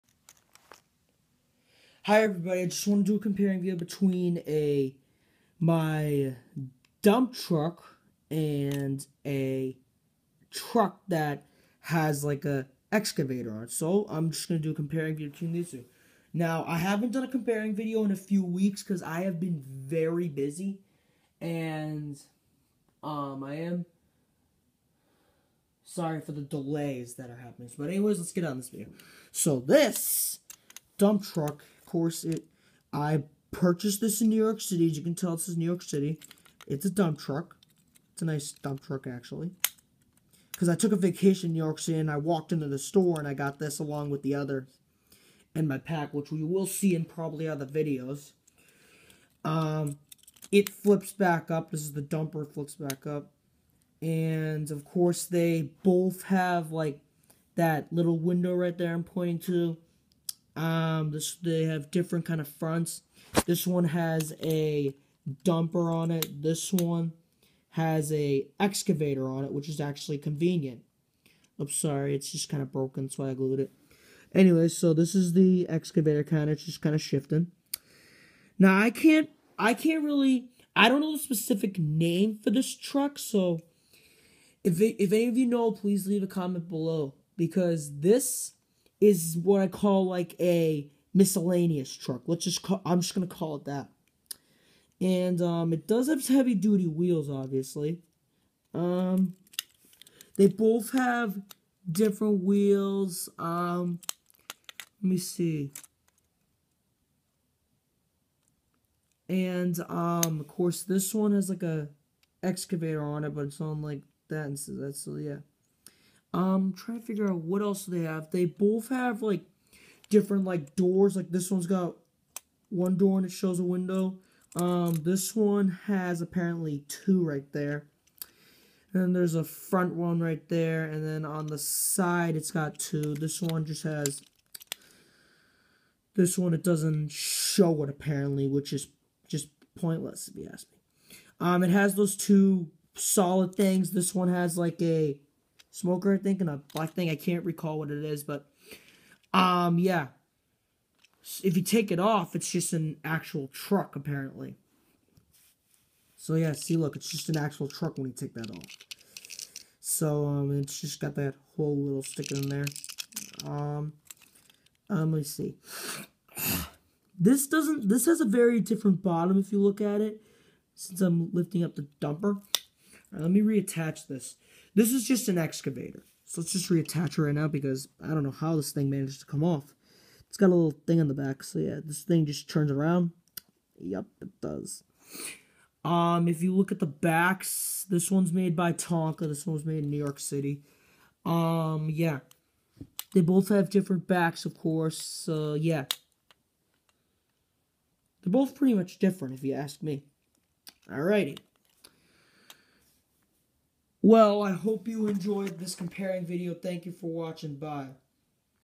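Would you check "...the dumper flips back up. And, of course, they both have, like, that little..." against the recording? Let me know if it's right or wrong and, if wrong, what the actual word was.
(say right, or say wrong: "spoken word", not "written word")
right.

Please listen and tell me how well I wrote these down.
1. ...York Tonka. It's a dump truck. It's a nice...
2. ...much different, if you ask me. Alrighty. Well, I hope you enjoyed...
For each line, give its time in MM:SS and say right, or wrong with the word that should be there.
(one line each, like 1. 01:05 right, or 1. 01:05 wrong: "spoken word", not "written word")
1. 00:35 wrong: "City", not "Tonka"
2. 03:18 right.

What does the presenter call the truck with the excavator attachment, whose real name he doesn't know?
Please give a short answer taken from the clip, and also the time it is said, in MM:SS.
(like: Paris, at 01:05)
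miscellaneous truck, at 01:31.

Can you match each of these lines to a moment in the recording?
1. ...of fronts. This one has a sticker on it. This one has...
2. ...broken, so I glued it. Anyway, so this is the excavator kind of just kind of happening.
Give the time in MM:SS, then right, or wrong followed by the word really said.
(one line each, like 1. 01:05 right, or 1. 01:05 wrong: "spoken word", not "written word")
1. 01:02 wrong: "dumper", not "sticker"
2. 01:12 wrong: "shifting", not "happening".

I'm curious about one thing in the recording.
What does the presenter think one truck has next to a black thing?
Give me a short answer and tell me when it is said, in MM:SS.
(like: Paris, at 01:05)
a smoker, at 02:24.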